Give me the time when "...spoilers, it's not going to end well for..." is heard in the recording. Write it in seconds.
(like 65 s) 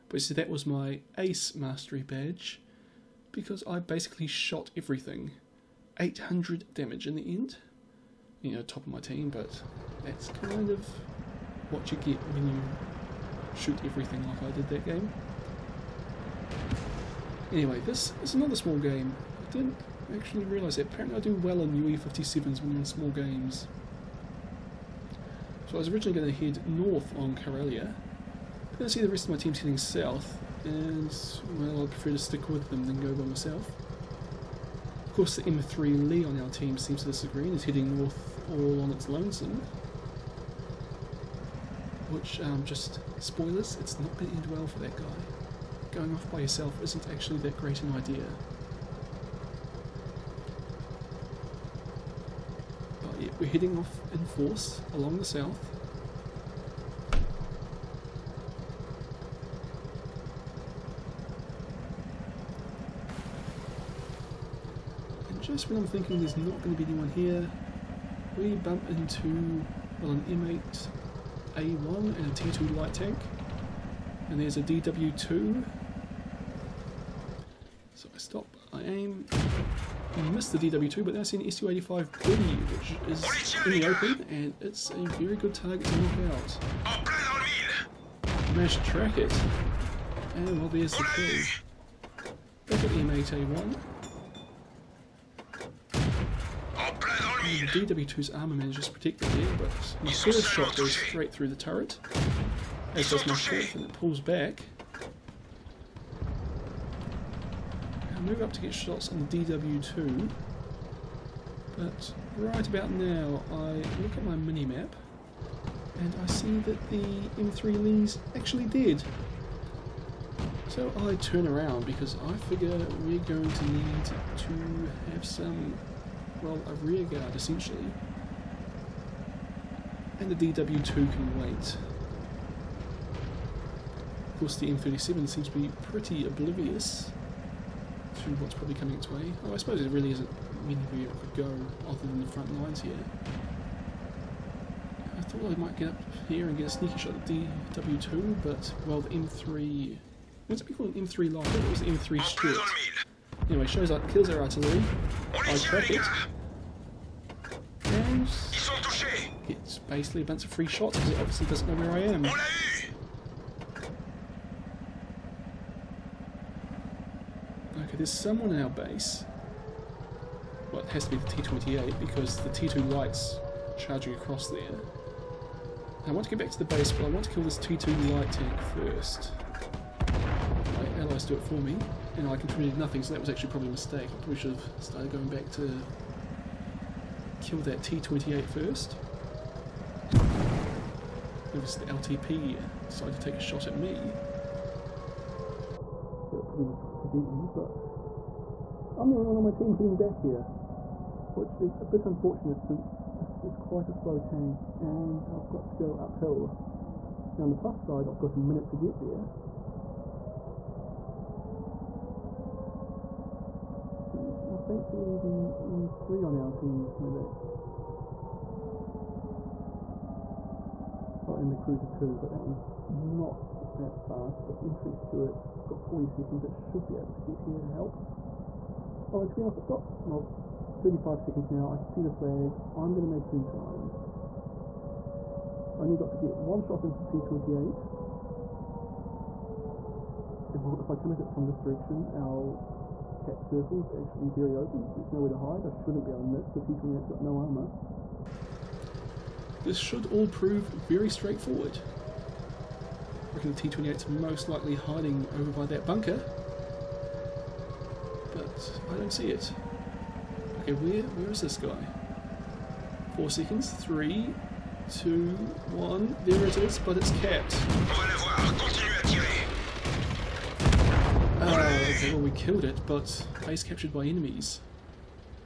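43 s.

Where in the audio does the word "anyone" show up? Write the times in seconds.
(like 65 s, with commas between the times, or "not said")
66 s.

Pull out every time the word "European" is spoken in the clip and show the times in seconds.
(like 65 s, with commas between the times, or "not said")
not said.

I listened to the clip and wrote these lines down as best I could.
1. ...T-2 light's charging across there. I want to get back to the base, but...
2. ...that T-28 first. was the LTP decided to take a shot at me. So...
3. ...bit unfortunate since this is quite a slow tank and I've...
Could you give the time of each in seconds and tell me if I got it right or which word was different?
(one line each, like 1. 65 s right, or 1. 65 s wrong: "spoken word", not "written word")
1. 172 s right
2. 187 s right
3. 201 s right.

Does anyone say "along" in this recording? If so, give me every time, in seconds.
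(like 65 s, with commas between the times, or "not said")
54 s.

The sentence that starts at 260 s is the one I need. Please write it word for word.
Okay, where where is this guy?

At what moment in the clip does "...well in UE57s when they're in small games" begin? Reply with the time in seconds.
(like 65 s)
21 s.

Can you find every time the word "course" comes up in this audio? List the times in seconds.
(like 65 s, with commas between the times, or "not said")
35 s, 134 s.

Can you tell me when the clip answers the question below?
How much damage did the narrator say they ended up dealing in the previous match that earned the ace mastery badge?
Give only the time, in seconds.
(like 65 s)
5 s.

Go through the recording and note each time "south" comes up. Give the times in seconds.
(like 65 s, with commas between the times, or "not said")
29 s, 55 s.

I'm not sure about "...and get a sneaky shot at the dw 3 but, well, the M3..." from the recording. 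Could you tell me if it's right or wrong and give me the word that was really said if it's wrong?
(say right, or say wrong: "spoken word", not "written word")
wrong: "2", not "3".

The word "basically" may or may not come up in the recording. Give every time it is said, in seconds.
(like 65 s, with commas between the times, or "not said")
3 s, 159 s.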